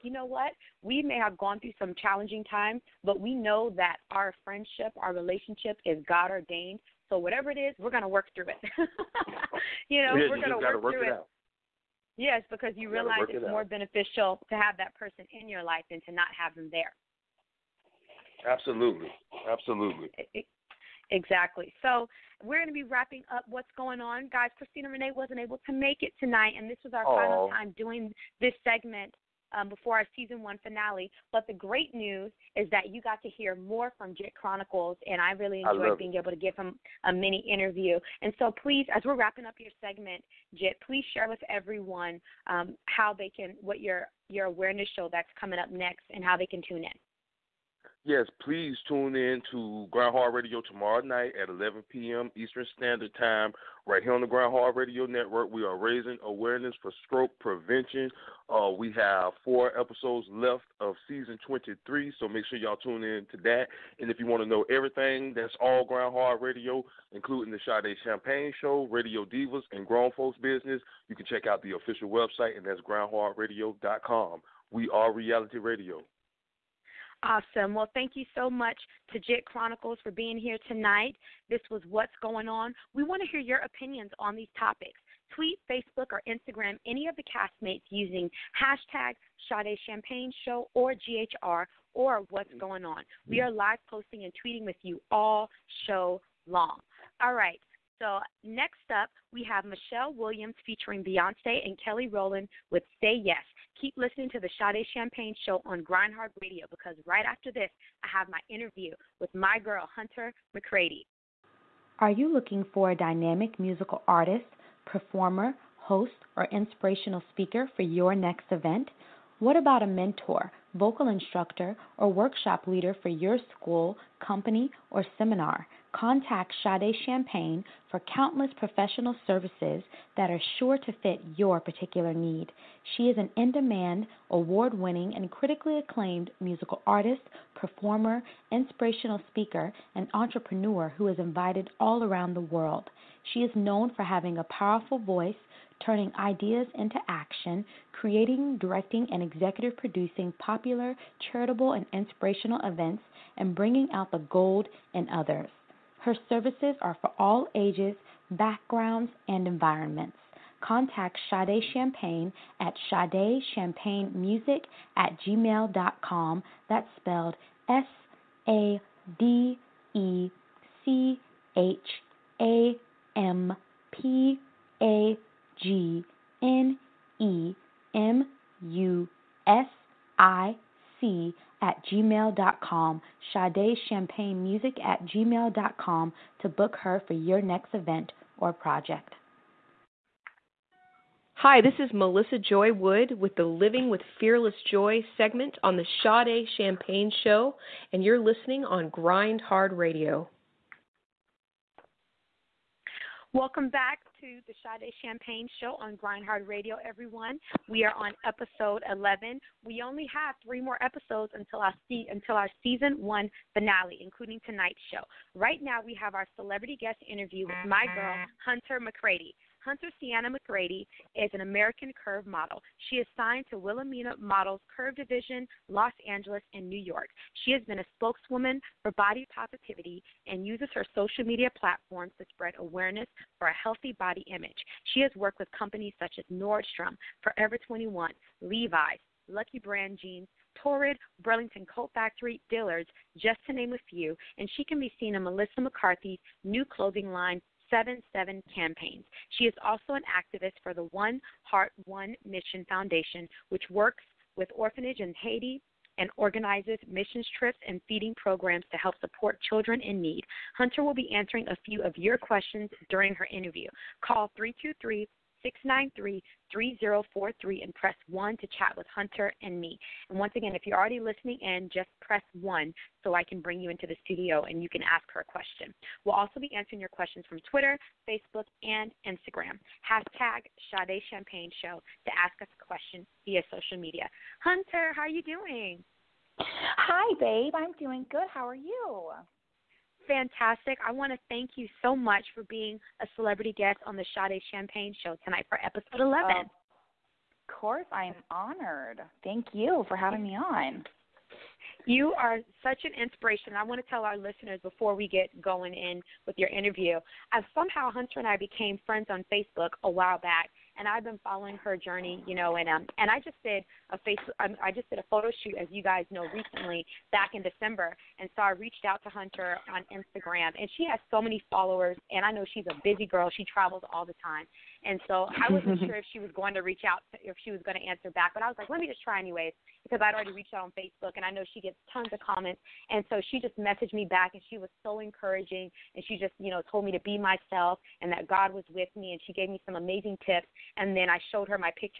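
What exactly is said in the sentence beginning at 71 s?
You can check out the official website, and that's grindhardradio.com.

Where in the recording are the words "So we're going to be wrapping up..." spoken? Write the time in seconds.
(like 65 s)
21 s.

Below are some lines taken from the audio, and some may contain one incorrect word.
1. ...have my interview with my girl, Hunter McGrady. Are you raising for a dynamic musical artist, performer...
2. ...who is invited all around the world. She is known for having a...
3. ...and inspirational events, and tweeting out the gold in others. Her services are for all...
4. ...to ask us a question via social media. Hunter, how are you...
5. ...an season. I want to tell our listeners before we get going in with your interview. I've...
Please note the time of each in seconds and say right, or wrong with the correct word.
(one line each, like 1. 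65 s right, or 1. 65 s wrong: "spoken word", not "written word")
1. 108 s wrong: "looking", not "raising"
2. 140 s right
3. 151 s wrong: "bringing", not "tweeting"
4. 282 s right
5. 302 s wrong: "inspiration", not "season".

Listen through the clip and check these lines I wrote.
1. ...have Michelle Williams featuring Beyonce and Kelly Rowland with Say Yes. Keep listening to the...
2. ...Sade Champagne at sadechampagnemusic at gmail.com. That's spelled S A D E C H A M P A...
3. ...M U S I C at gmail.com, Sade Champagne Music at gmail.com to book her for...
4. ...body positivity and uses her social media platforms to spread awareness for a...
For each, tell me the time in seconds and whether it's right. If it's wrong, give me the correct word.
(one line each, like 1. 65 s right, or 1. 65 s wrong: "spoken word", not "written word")
1. 99 s right
2. 161 s right
3. 177 s right
4. 228 s right.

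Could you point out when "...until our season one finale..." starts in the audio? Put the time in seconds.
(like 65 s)
212 s.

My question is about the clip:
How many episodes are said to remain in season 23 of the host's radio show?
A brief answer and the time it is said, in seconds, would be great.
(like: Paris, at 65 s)
4, at 59 s.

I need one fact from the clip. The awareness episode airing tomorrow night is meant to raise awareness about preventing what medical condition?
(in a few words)
Stroke.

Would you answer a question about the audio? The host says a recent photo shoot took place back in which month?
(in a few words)
December.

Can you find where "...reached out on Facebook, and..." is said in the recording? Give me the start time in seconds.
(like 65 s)
330 s.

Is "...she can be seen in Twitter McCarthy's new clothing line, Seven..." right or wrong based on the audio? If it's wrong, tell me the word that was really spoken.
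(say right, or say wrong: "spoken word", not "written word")
wrong: "Melissa", not "Twitter".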